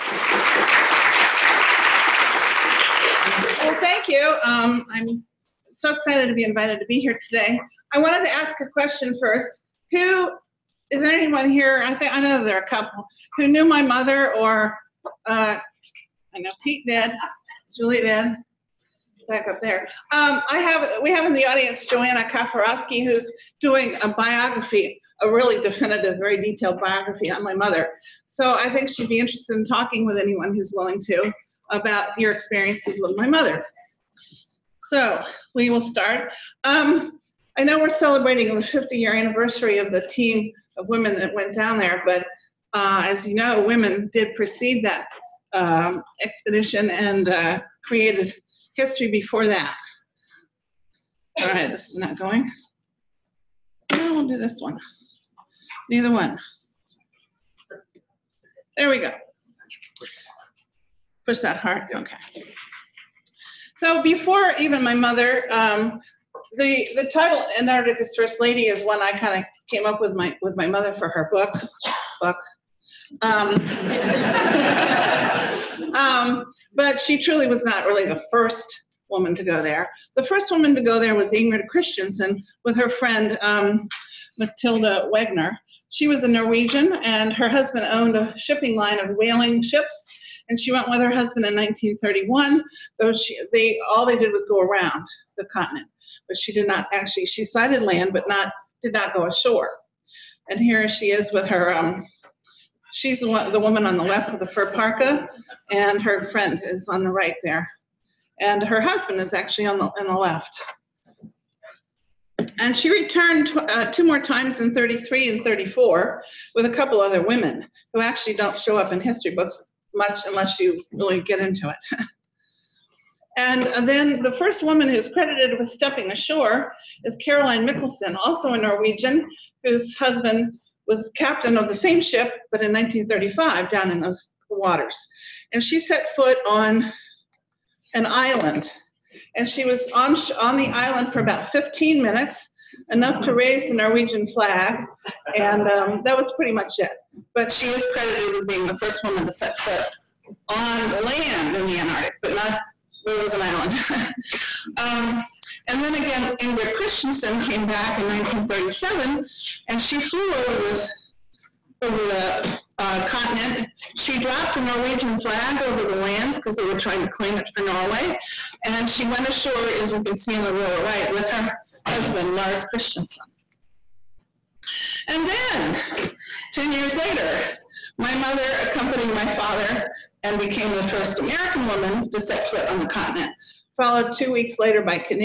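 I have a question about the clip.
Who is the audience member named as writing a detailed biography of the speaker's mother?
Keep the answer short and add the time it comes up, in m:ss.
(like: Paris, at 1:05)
Joanna Kafarowski, at 0:21.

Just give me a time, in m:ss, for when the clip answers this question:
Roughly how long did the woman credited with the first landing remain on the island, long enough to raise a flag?
2:21.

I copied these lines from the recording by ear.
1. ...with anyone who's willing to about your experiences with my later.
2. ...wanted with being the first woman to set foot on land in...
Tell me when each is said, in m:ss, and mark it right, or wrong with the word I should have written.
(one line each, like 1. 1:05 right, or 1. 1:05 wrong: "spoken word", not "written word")
1. 0:30 wrong: "mother", not "later"
2. 2:27 wrong: "credited", not "wanted".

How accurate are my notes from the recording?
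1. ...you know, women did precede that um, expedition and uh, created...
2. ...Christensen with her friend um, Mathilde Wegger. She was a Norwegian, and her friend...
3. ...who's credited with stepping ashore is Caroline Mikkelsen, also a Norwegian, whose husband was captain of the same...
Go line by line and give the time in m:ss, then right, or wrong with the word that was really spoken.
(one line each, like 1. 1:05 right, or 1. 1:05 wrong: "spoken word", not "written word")
1. 0:43 right
2. 1:21 wrong: "husband", not "friend"
3. 2:04 right.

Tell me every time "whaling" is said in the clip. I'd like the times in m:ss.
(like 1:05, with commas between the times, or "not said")
1:29.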